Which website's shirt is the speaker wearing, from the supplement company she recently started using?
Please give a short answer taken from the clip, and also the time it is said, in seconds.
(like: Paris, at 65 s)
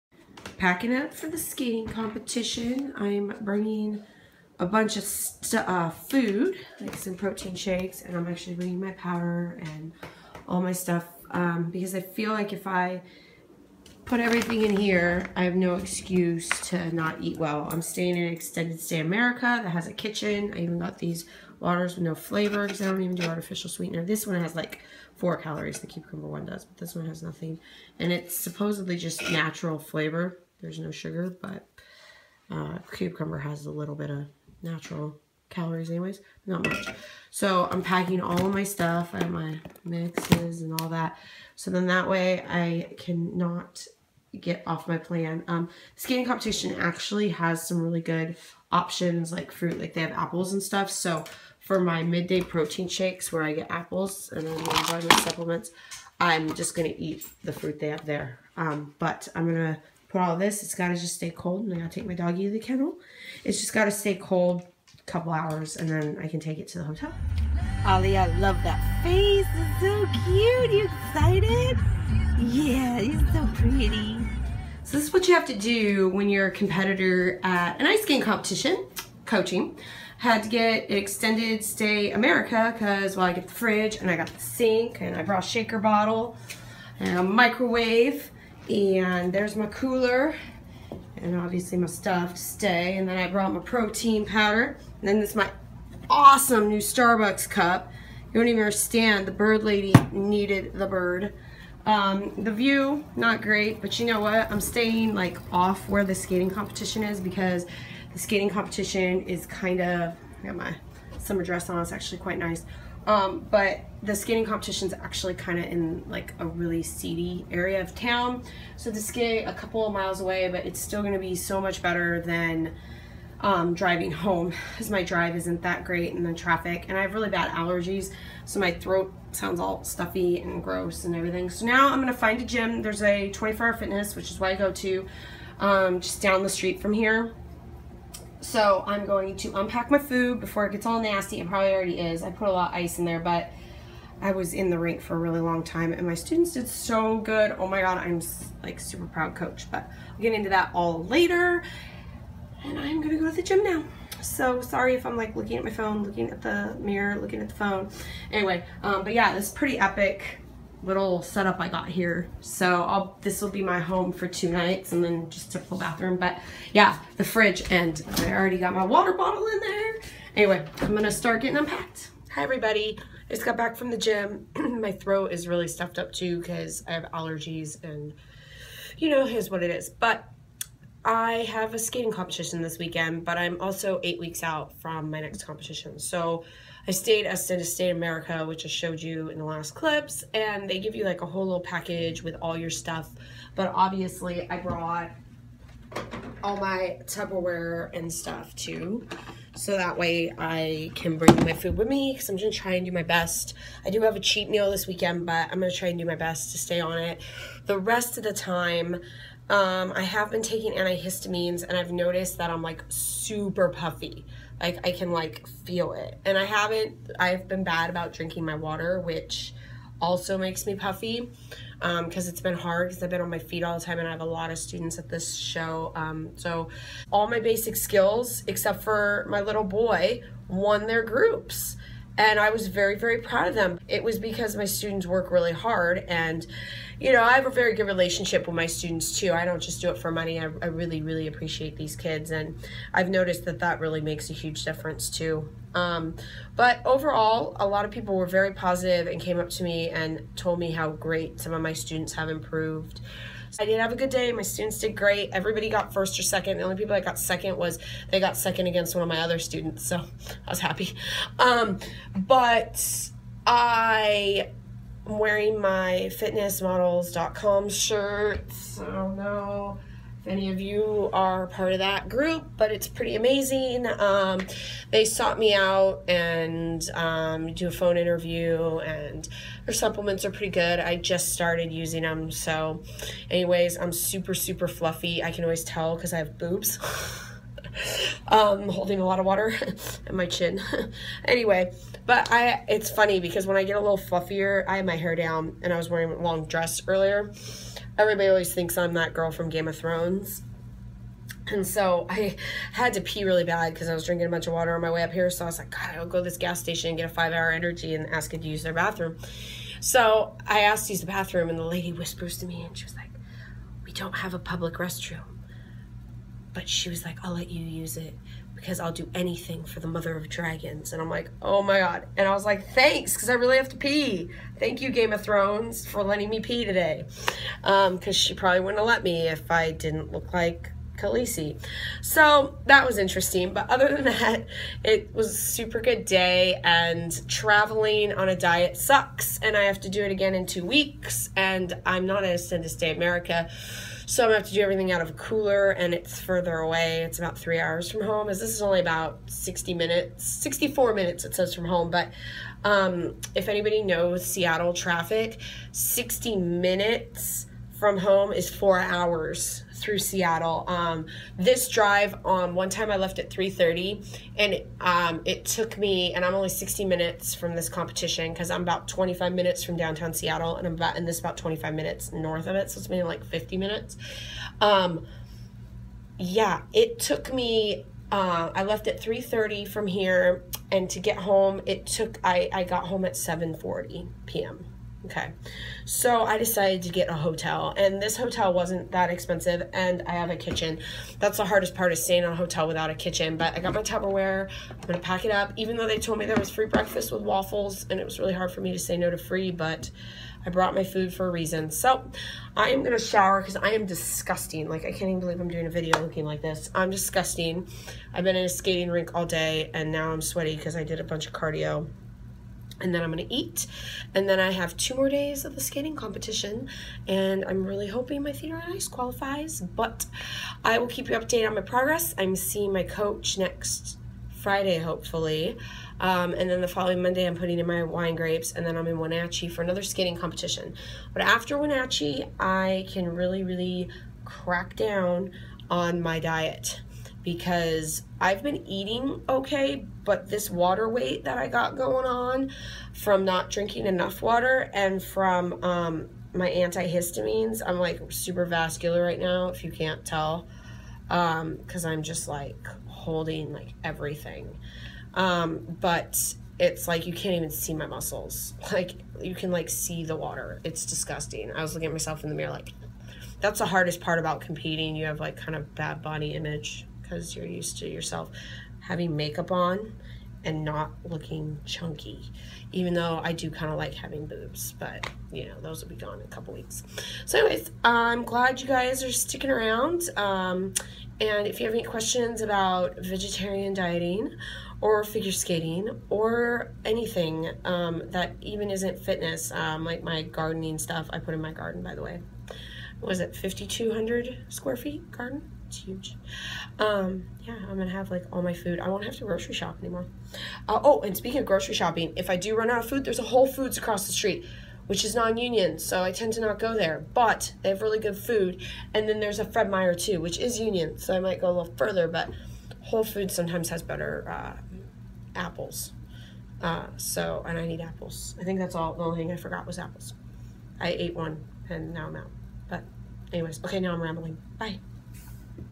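fitnessmodels.com, at 266 s.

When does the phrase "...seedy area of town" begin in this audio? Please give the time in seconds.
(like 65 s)
116 s.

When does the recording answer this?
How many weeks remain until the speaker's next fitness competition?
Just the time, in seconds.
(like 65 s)
184 s.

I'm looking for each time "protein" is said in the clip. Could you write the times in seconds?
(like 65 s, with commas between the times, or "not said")
7 s, 52 s, 93 s.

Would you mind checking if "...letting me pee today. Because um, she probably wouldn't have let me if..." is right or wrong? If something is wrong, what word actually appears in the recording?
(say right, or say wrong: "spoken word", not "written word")
right.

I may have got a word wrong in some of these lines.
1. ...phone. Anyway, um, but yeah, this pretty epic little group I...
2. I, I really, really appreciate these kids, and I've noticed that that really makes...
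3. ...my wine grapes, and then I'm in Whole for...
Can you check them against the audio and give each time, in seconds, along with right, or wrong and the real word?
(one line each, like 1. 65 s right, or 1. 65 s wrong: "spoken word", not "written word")
1. 157 s wrong: "setup", not "group"
2. 240 s right
3. 427 s wrong: "Wenatchee", not "Whole".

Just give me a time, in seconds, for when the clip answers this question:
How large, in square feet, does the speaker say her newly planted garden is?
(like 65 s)
493 s.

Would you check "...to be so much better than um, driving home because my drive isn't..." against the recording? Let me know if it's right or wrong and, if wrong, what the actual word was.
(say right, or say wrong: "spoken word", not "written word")
right.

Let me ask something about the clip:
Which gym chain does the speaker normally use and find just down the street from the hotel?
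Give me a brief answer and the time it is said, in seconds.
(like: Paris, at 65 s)
24 Hour Fitness, at 133 s.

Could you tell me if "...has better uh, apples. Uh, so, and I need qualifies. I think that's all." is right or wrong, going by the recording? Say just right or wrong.
wrong.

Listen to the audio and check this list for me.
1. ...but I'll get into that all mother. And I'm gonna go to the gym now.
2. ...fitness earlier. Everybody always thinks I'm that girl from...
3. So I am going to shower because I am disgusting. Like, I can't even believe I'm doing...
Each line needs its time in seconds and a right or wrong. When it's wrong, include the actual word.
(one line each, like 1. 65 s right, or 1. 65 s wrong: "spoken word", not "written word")
1. 149 s wrong: "later", not "mother"
2. 296 s wrong: "dress", not "fitness"
3. 401 s right.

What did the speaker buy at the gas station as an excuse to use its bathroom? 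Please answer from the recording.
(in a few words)
five hour energy.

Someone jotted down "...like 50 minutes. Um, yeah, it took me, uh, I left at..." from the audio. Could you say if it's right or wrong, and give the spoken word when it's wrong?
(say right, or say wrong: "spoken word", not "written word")
right.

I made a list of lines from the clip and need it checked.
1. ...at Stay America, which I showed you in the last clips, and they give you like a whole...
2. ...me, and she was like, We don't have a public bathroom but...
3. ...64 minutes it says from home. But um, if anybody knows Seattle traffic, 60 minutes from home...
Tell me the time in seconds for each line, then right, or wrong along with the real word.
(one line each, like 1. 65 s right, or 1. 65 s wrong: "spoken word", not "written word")
1. 187 s right
2. 312 s wrong: "restroom", not "bathroom"
3. 350 s right.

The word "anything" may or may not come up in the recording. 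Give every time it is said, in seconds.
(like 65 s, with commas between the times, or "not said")
319 s, 486 s.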